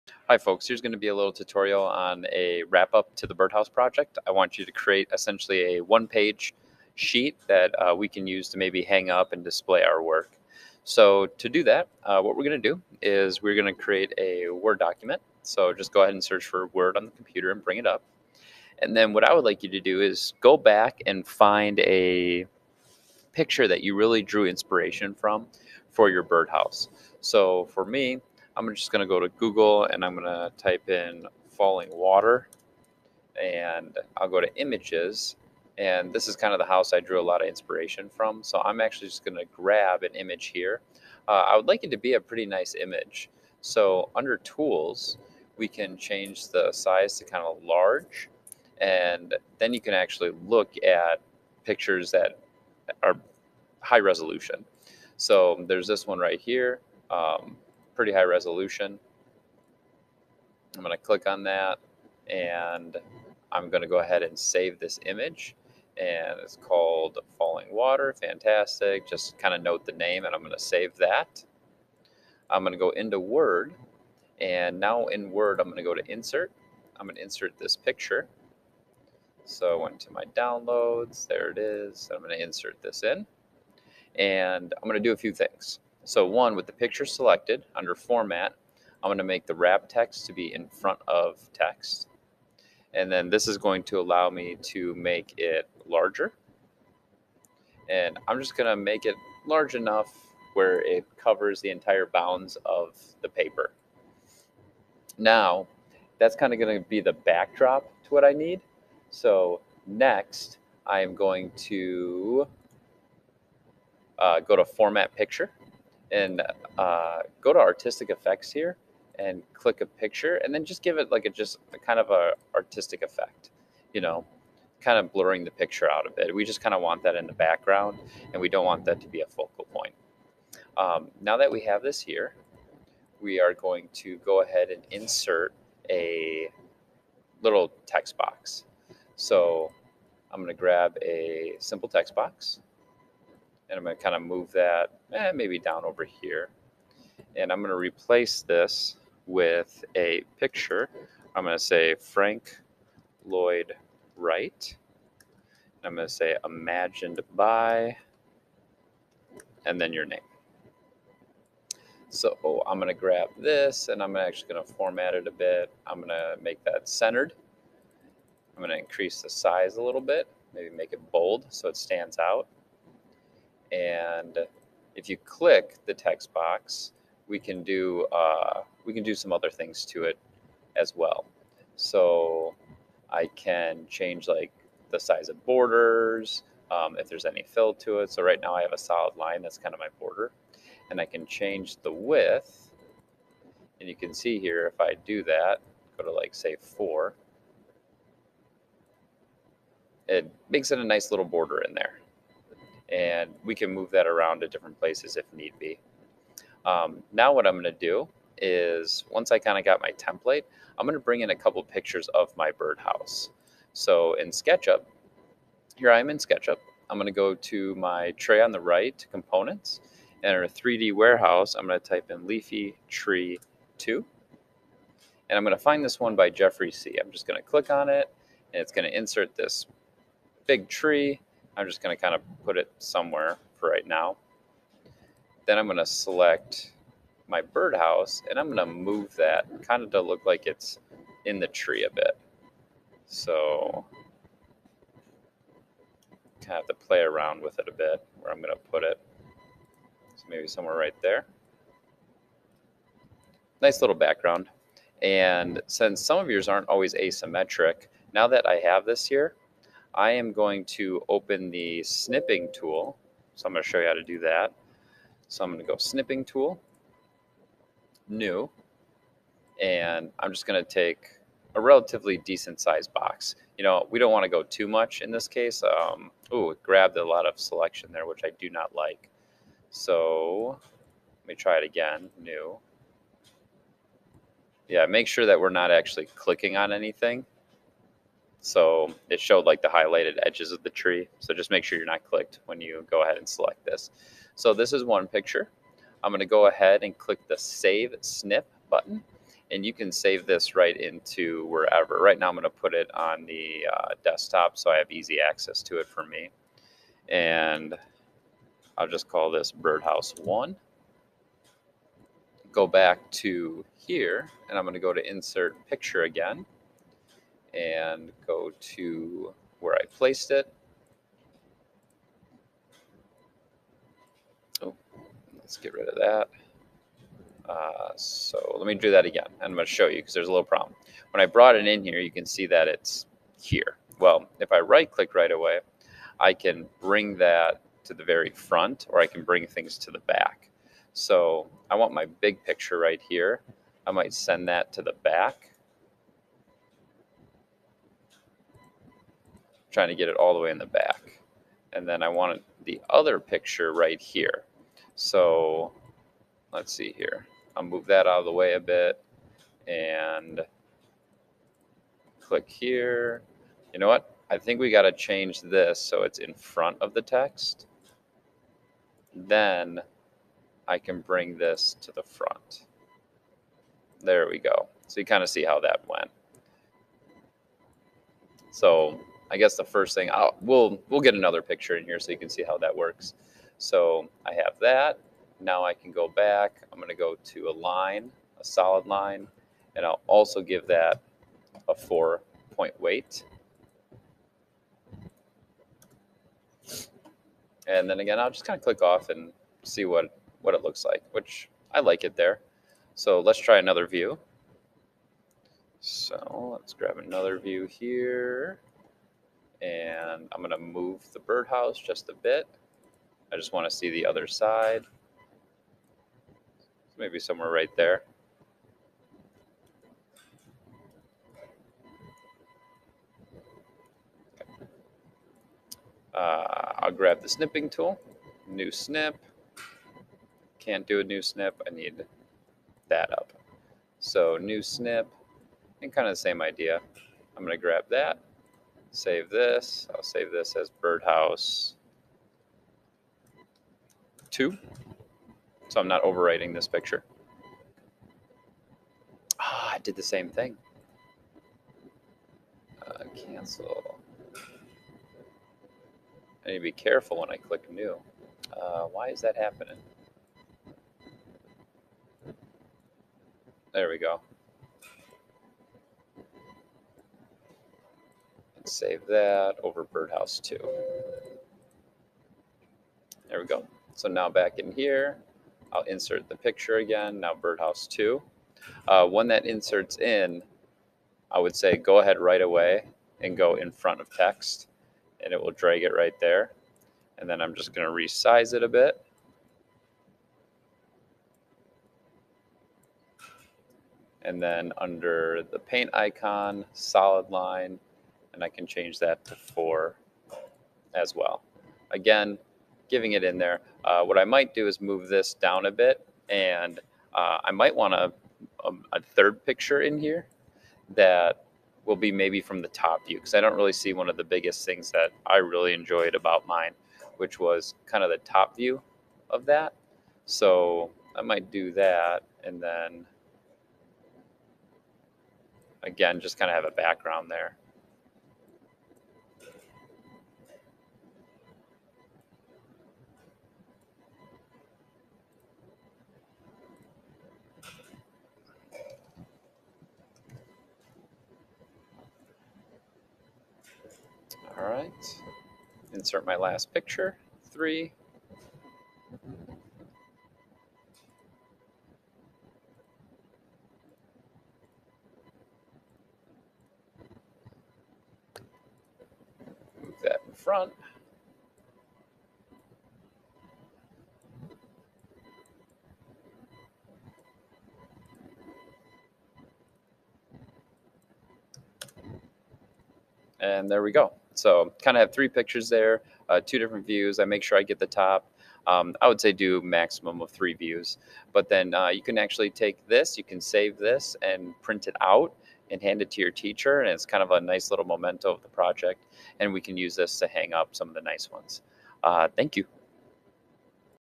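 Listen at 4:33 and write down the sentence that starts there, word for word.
You know, we don't want to go too much in this case.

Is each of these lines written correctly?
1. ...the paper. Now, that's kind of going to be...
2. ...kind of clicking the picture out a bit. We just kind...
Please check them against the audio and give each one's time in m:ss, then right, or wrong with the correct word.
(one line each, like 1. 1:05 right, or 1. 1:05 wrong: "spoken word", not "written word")
1. 1:43 right
2. 2:04 wrong: "blurring", not "clicking".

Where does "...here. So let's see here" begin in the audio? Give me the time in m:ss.
5:54.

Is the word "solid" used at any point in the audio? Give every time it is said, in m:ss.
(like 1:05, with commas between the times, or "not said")
3:08, 6:28, 8:16.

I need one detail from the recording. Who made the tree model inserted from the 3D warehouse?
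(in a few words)
Jeffrey C.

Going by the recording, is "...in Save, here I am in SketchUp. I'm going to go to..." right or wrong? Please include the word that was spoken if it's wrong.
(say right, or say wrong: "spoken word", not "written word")
wrong: "SketchUp", not "Save".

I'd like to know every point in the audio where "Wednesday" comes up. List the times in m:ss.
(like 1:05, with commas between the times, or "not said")
not said.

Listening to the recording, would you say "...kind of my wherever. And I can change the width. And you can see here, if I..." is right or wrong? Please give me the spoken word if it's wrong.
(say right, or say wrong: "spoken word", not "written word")
wrong: "border", not "wherever".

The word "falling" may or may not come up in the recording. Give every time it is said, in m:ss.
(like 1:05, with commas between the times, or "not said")
0:31, 1:07.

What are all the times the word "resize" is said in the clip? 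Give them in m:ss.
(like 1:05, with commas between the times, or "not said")
8:07.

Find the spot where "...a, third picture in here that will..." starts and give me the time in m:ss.
8:28.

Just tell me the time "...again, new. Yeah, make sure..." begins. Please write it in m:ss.
4:41.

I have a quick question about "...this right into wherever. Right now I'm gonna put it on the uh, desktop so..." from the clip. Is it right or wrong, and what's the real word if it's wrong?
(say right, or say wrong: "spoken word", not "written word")
right.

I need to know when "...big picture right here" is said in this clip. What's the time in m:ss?
5:42.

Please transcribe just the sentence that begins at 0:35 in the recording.
And this is kind of the house I drew a lot of inspiration from.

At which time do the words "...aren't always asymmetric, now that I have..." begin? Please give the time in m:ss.
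4:16.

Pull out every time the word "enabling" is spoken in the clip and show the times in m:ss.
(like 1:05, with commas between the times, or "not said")
not said.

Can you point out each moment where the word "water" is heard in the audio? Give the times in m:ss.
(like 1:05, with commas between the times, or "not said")
0:31, 1:07.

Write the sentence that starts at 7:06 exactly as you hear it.
Uh, I'll grab the snipping tool, new snip.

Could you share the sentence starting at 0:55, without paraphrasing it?
So there's this one right here.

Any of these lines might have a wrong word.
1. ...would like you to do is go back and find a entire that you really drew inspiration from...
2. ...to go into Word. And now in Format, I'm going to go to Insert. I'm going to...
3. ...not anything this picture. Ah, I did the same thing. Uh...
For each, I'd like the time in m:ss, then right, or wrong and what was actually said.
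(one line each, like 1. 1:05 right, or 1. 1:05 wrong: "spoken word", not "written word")
1. 0:19 wrong: "picture", not "entire"
2. 1:12 wrong: "Word", not "Format"
3. 7:25 wrong: "overwriting", not "anything".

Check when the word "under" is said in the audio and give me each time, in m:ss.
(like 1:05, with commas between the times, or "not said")
0:44, 1:27, 8:14.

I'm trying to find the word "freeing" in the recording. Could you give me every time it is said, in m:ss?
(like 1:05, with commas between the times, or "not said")
not said.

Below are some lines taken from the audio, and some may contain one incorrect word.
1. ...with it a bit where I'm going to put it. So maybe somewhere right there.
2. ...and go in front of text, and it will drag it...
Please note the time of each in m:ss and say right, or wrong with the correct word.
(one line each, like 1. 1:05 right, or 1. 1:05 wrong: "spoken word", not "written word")
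1. 4:07 right
2. 8:03 right.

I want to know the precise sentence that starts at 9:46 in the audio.
And it's kind of a nice little memento of the project.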